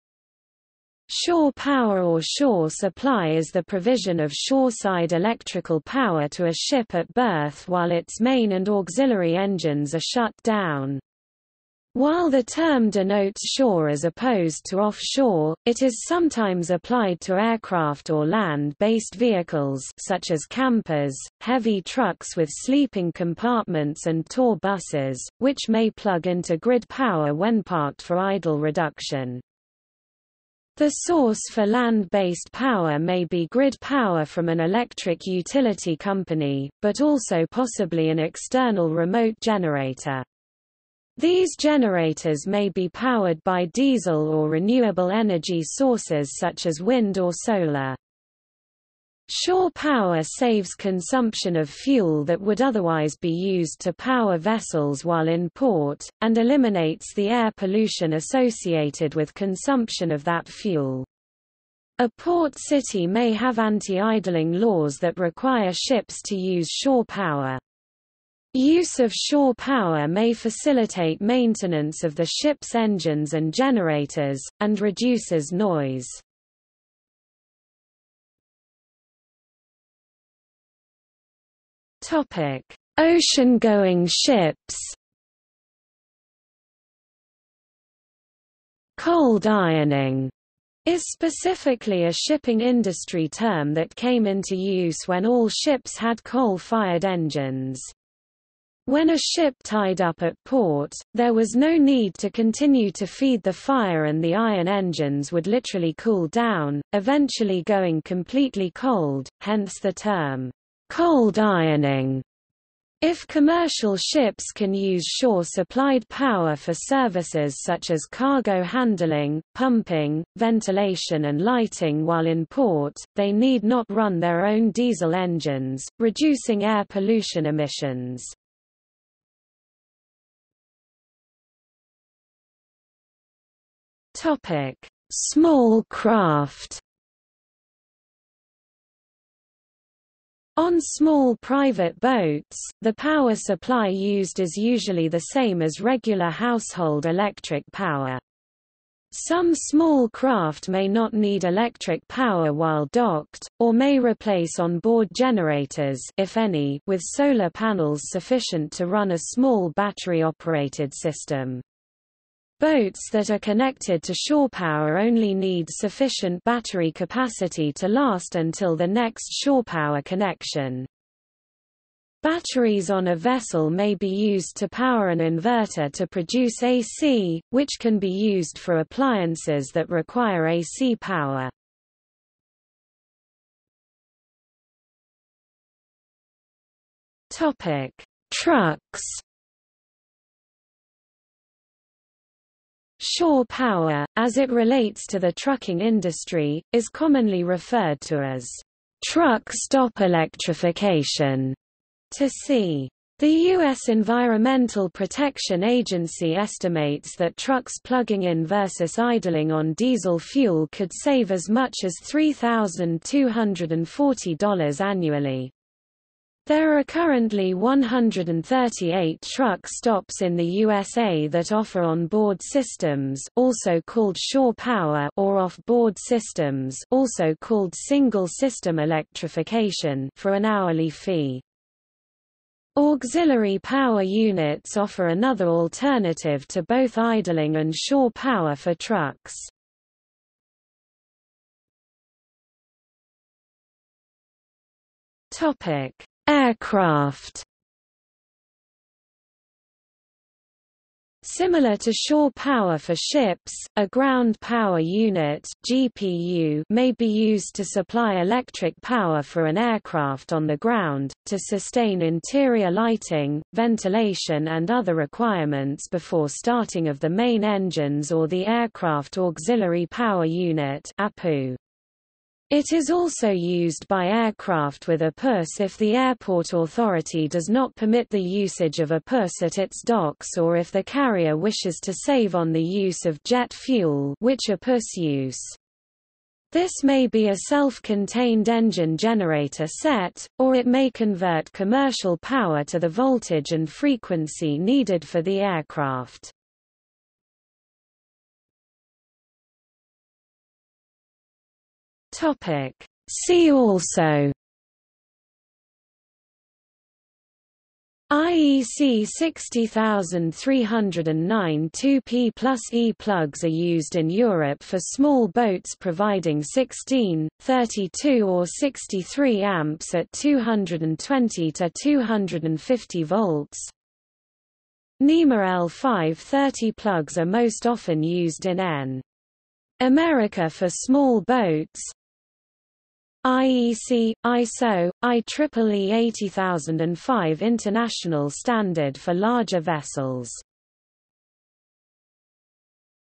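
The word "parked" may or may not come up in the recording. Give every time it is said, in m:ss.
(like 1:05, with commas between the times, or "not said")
0:27.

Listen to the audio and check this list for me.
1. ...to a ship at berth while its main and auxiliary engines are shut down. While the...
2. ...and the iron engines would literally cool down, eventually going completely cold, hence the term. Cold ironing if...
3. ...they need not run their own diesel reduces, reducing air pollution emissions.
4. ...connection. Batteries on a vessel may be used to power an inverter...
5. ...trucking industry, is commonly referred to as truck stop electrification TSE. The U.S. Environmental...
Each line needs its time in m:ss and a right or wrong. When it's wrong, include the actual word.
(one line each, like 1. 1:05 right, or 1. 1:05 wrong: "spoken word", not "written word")
1. 0:06 right
2. 1:44 right
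3. 2:03 wrong: "engines", not "reduces"
4. 2:50 right
5. 3:15 right.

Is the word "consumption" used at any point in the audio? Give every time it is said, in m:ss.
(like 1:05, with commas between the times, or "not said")
0:50, 0:59.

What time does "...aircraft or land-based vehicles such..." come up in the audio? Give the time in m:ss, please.
0:17.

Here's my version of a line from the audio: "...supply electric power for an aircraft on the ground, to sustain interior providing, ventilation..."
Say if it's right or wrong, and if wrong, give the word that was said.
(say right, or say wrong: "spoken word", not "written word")
wrong: "lighting", not "providing".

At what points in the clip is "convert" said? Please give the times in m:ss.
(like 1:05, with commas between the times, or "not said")
4:50.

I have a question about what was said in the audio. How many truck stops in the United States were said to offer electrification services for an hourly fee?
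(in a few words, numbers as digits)
138.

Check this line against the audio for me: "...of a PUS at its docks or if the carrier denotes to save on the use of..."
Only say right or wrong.
wrong.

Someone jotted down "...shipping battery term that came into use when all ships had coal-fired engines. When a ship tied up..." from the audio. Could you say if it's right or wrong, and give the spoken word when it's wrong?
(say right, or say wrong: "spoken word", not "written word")
wrong: "industry", not "battery".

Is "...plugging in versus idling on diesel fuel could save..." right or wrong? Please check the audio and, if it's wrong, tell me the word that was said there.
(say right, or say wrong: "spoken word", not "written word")
right.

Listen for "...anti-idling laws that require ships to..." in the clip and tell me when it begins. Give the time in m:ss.
1:03.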